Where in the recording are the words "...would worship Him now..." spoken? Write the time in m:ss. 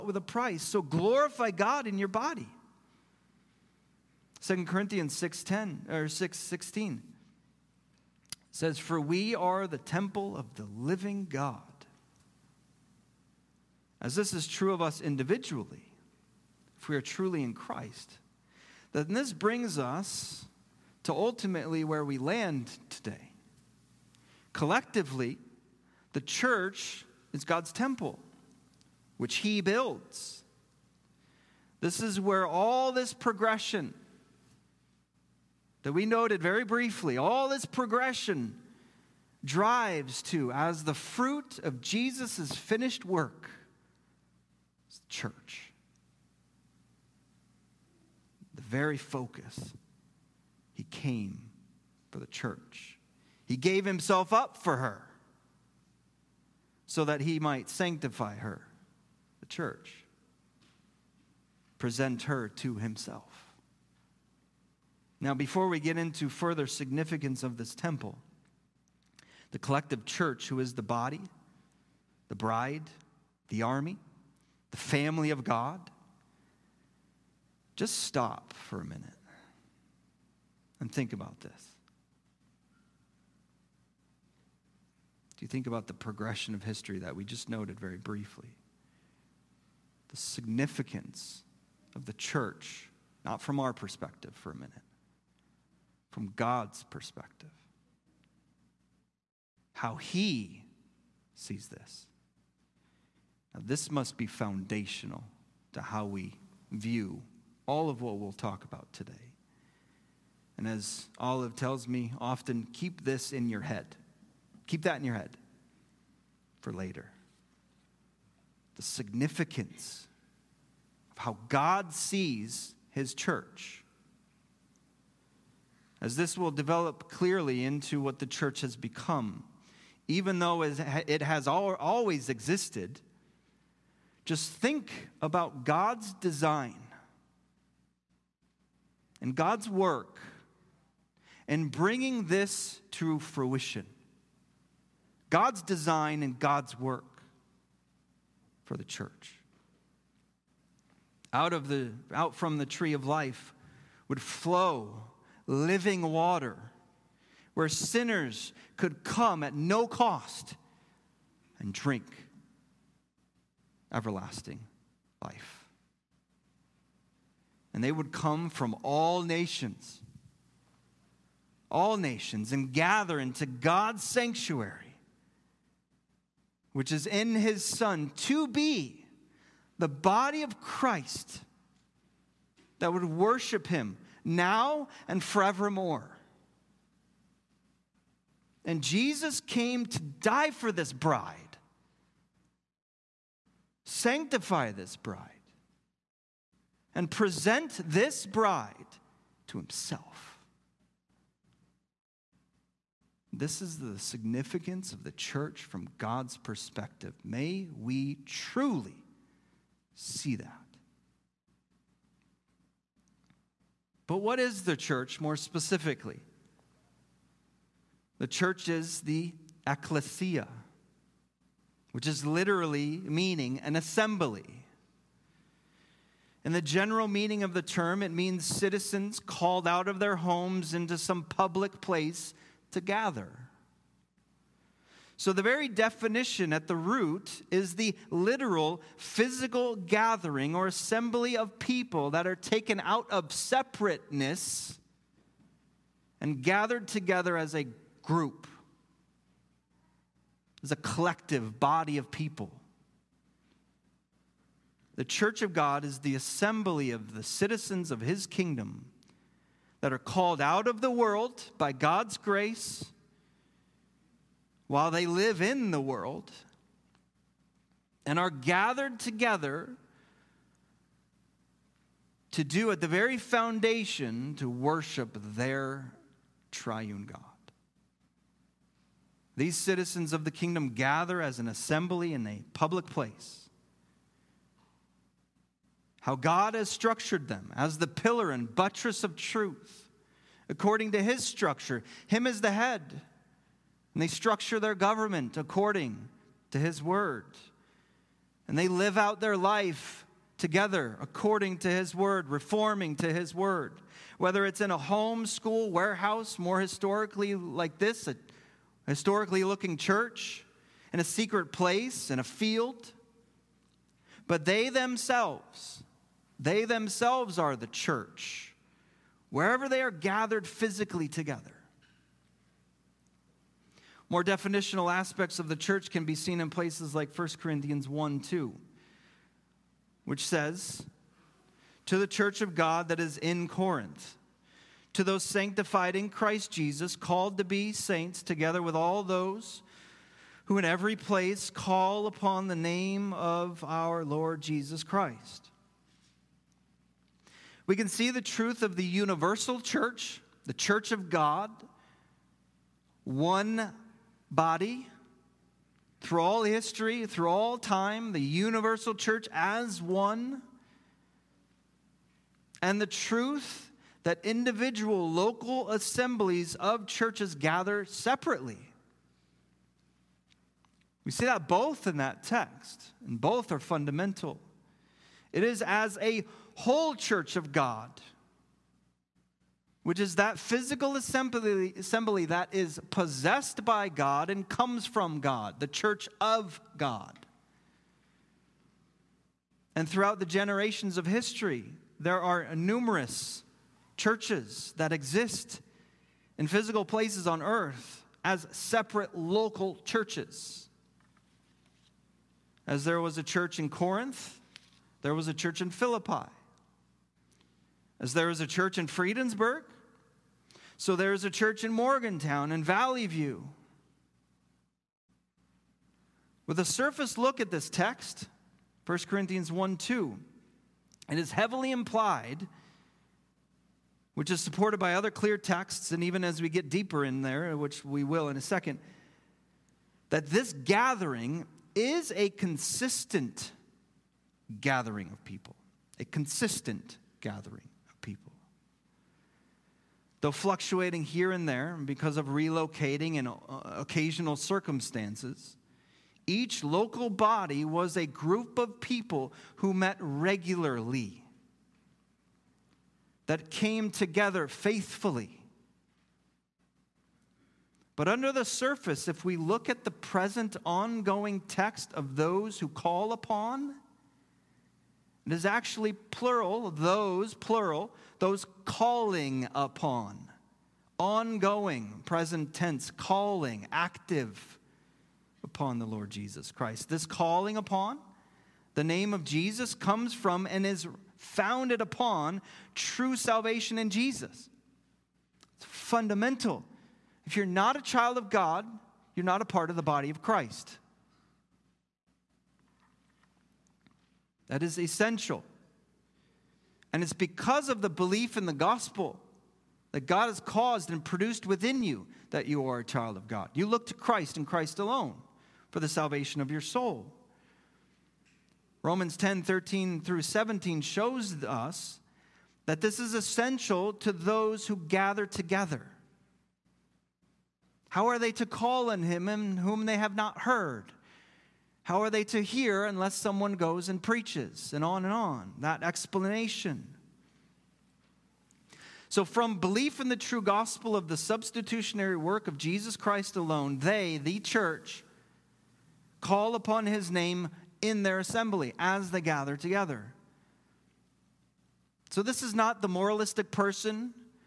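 3:02.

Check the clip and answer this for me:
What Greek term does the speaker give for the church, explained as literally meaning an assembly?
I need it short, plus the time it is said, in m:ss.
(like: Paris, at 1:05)
ecclesia, at 3:39.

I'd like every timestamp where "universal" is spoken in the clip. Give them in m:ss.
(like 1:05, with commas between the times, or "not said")
5:48, 5:58.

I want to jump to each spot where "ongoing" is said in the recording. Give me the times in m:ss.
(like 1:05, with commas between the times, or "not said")
7:40, 7:50.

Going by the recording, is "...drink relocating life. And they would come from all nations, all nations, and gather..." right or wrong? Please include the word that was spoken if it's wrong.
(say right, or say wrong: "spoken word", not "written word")
wrong: "everlasting", not "relocating".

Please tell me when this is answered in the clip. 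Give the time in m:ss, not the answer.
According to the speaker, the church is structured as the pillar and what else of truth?
4:48.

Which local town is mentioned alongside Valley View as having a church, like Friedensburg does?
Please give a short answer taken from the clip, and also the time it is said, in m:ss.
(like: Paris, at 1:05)
Morgantown, at 6:51.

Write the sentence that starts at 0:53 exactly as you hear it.
He gave himself up for her so that he might sanctify her, the church, present her to himself.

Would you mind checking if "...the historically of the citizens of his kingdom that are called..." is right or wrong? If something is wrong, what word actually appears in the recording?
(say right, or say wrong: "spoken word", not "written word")
wrong: "assembly", not "historically".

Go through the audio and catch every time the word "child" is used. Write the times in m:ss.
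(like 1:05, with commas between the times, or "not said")
8:07, 8:22.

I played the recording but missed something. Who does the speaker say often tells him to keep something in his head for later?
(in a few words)
Olive.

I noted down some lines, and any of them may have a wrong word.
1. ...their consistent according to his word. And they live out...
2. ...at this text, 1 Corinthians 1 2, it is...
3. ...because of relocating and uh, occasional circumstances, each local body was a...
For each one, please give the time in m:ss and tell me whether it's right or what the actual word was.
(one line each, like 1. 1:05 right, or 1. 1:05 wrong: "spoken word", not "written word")
1. 4:54 wrong: "government", not "consistent"
2. 6:57 right
3. 7:21 right.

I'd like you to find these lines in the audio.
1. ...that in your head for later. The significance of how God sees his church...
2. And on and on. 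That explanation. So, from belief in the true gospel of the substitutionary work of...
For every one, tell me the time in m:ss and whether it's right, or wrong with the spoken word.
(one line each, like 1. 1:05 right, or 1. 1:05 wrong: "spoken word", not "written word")
1. 1:54 right
2. 8:44 right.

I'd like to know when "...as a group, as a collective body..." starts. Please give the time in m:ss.
4:07.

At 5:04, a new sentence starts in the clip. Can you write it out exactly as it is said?
Whether it's in a home, school, warehouse, more historically like this, a historically looking church, in a secret place, in a field.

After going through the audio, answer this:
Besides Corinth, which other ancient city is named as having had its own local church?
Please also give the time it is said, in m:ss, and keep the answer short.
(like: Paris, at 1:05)
Philippi, at 6:45.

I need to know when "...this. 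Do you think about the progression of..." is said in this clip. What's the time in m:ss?
1:21.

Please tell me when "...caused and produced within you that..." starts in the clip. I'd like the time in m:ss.
8:20.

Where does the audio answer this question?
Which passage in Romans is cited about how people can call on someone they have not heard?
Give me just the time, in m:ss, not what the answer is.
8:28.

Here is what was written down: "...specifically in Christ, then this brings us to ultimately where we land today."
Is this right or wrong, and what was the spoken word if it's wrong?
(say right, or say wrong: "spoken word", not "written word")
wrong: "truly", not "specifically".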